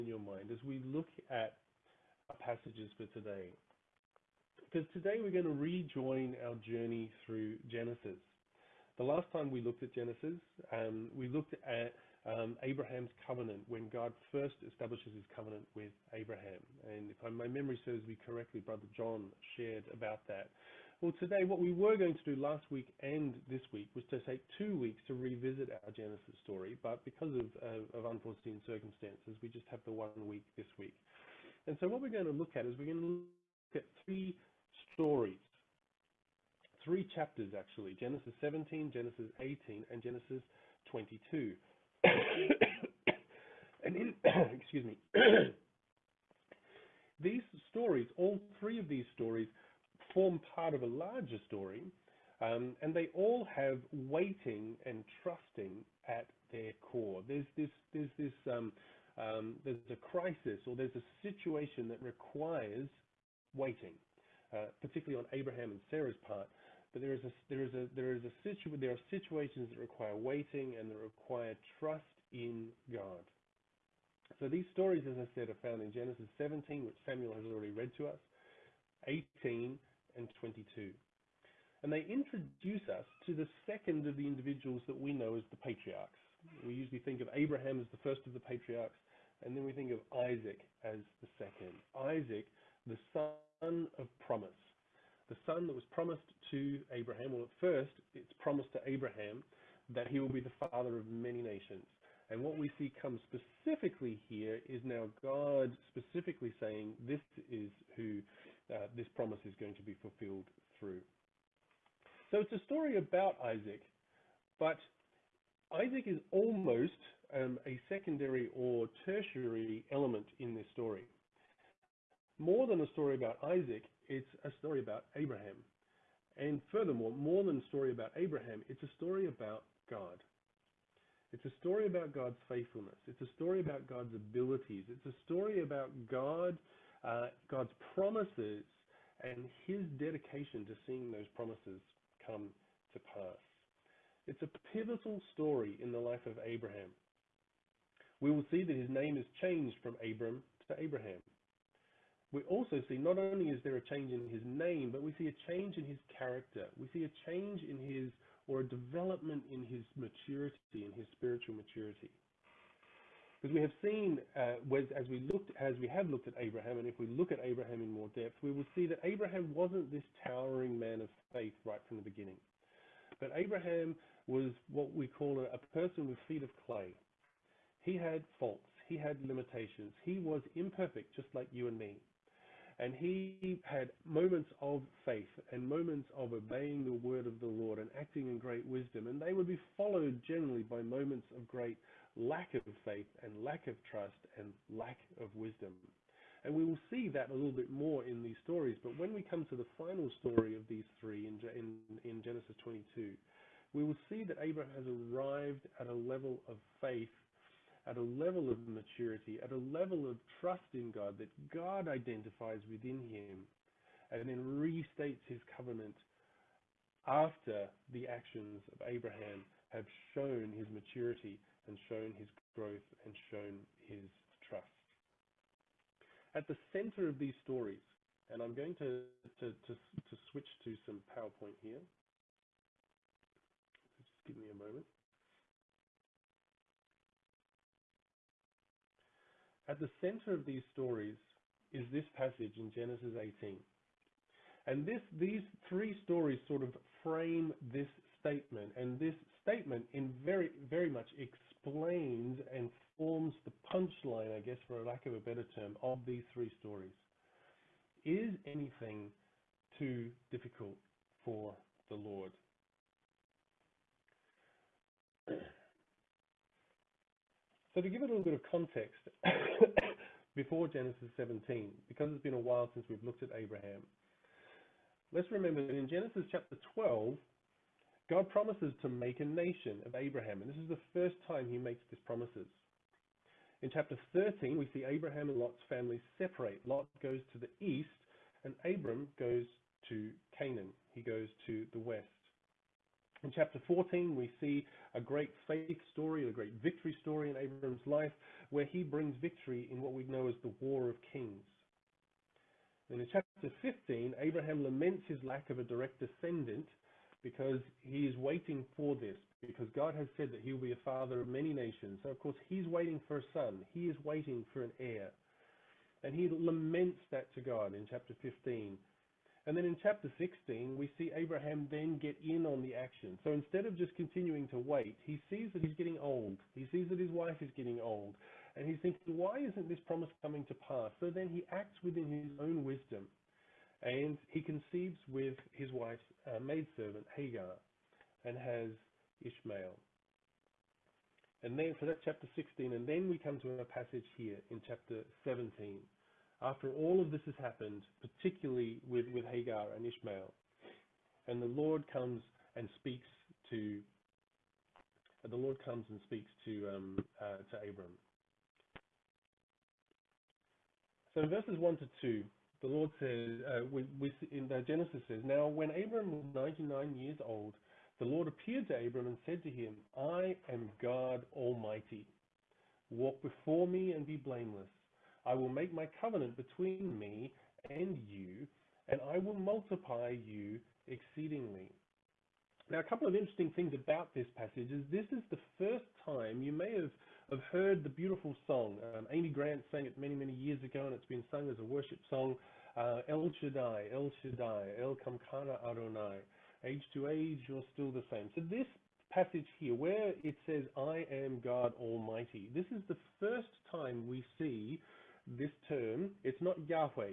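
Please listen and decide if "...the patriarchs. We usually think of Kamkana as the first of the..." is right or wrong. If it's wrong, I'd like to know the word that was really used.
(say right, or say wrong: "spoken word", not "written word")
wrong: "Abraham", not "Kamkana".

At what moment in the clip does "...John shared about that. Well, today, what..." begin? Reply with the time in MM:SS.
00:18.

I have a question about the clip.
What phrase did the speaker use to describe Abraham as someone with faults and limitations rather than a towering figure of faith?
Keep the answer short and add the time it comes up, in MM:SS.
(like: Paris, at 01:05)
feet of clay, at 02:56.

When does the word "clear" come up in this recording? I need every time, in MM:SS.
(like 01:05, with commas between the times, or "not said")
not said.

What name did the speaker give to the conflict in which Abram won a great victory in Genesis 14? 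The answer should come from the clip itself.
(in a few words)
War of Kings.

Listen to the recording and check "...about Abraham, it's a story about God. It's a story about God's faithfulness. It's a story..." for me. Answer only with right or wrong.
right.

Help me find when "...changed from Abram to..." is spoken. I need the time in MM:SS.
02:29.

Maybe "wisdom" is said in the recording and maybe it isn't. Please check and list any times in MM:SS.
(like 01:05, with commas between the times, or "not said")
03:08, 03:15, 05:32.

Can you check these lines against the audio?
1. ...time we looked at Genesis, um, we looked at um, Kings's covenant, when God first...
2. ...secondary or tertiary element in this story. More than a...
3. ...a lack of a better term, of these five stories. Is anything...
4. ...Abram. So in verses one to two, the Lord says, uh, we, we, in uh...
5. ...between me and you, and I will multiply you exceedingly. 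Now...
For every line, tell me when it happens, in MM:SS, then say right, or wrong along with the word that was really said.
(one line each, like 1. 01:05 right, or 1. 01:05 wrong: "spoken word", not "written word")
1. 00:09 wrong: "Abraham", not "Kings"
2. 01:57 right
3. 04:14 wrong: "three", not "five"
4. 05:57 right
5. 06:16 right.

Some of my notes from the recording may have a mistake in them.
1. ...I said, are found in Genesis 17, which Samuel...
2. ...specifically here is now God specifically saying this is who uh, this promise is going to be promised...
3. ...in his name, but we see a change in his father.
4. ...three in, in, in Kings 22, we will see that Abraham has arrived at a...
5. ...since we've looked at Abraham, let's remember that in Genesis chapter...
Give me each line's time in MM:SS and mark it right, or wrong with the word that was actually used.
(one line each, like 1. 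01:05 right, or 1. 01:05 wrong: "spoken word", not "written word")
1. 01:15 right
2. 01:43 wrong: "fulfilled", not "promised"
3. 02:34 wrong: "character", not "father"
4. 03:21 wrong: "Genesis", not "Kings"
5. 04:32 right.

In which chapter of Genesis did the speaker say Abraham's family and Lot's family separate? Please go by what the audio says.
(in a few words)
chapter 13.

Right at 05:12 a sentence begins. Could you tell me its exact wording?
So, of course, he's waiting for a son, he is waiting for an heir.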